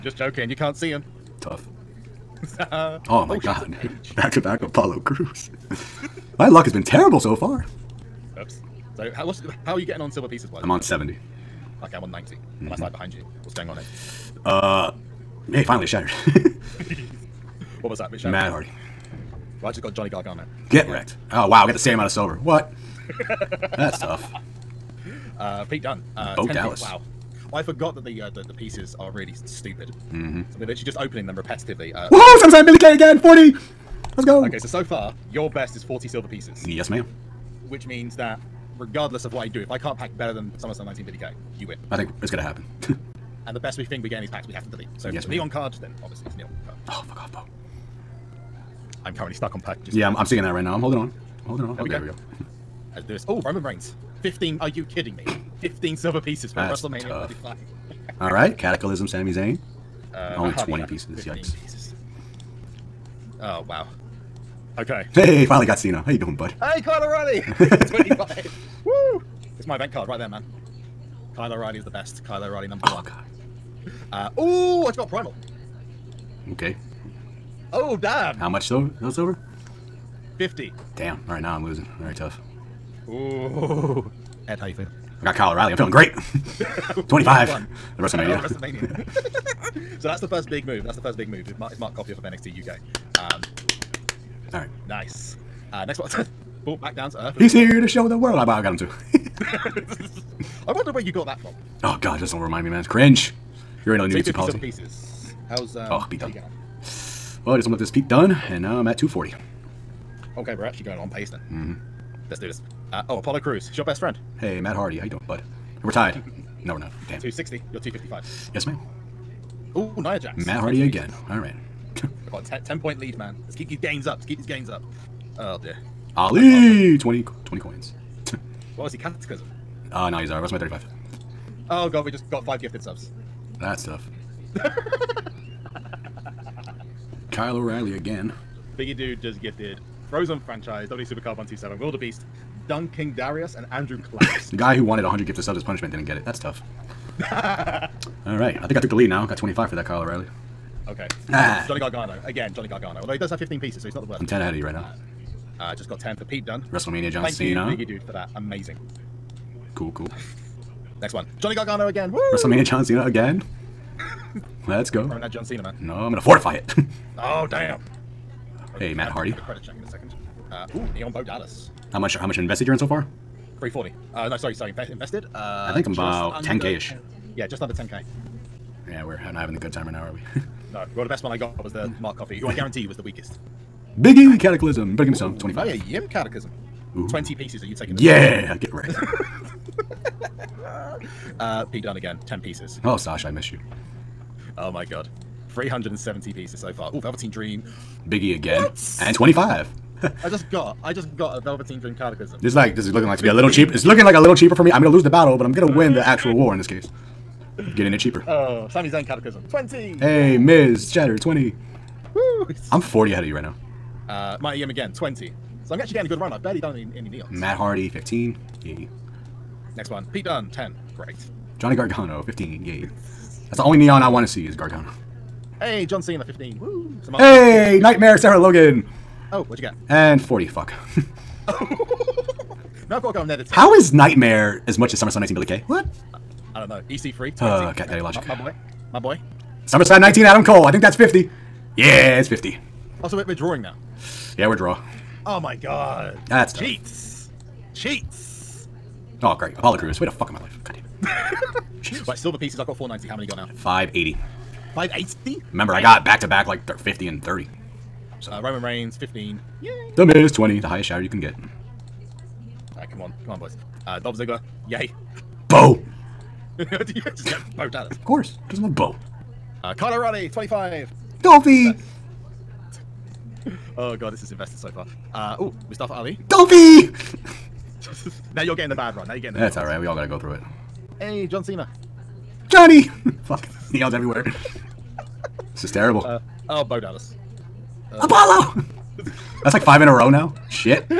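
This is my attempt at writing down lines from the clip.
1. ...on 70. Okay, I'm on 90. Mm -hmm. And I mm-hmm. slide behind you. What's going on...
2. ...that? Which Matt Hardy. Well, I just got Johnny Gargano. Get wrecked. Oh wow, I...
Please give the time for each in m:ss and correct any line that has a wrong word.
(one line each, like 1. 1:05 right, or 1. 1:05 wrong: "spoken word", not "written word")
1. 0:10 right
2. 0:17 right.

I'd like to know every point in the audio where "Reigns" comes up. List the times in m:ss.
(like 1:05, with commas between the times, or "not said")
0:53, 4:18.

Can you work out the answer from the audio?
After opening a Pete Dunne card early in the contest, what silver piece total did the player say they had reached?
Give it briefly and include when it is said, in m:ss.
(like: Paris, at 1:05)
240, at 1:48.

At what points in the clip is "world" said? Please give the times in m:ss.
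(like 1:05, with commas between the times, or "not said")
1:38.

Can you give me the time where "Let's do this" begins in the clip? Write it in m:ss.
1:52.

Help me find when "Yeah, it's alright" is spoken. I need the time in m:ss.
4:39.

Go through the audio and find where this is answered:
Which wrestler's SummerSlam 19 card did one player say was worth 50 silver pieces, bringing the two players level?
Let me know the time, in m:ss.
4:00.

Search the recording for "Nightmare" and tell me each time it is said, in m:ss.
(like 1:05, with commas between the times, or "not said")
3:47, 3:53.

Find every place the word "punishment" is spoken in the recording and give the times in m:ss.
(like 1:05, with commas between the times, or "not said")
2:25.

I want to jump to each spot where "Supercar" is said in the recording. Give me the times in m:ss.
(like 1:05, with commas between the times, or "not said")
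2:21.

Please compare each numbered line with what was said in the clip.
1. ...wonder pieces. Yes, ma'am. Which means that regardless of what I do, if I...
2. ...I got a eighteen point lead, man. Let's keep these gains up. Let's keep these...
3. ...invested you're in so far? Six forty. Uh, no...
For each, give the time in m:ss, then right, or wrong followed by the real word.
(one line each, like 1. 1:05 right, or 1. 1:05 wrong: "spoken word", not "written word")
1. 0:36 wrong: "silver", not "wonder"
2. 2:02 wrong: "ten", not "eighteen"
3. 2:52 wrong: "Three", not "Six".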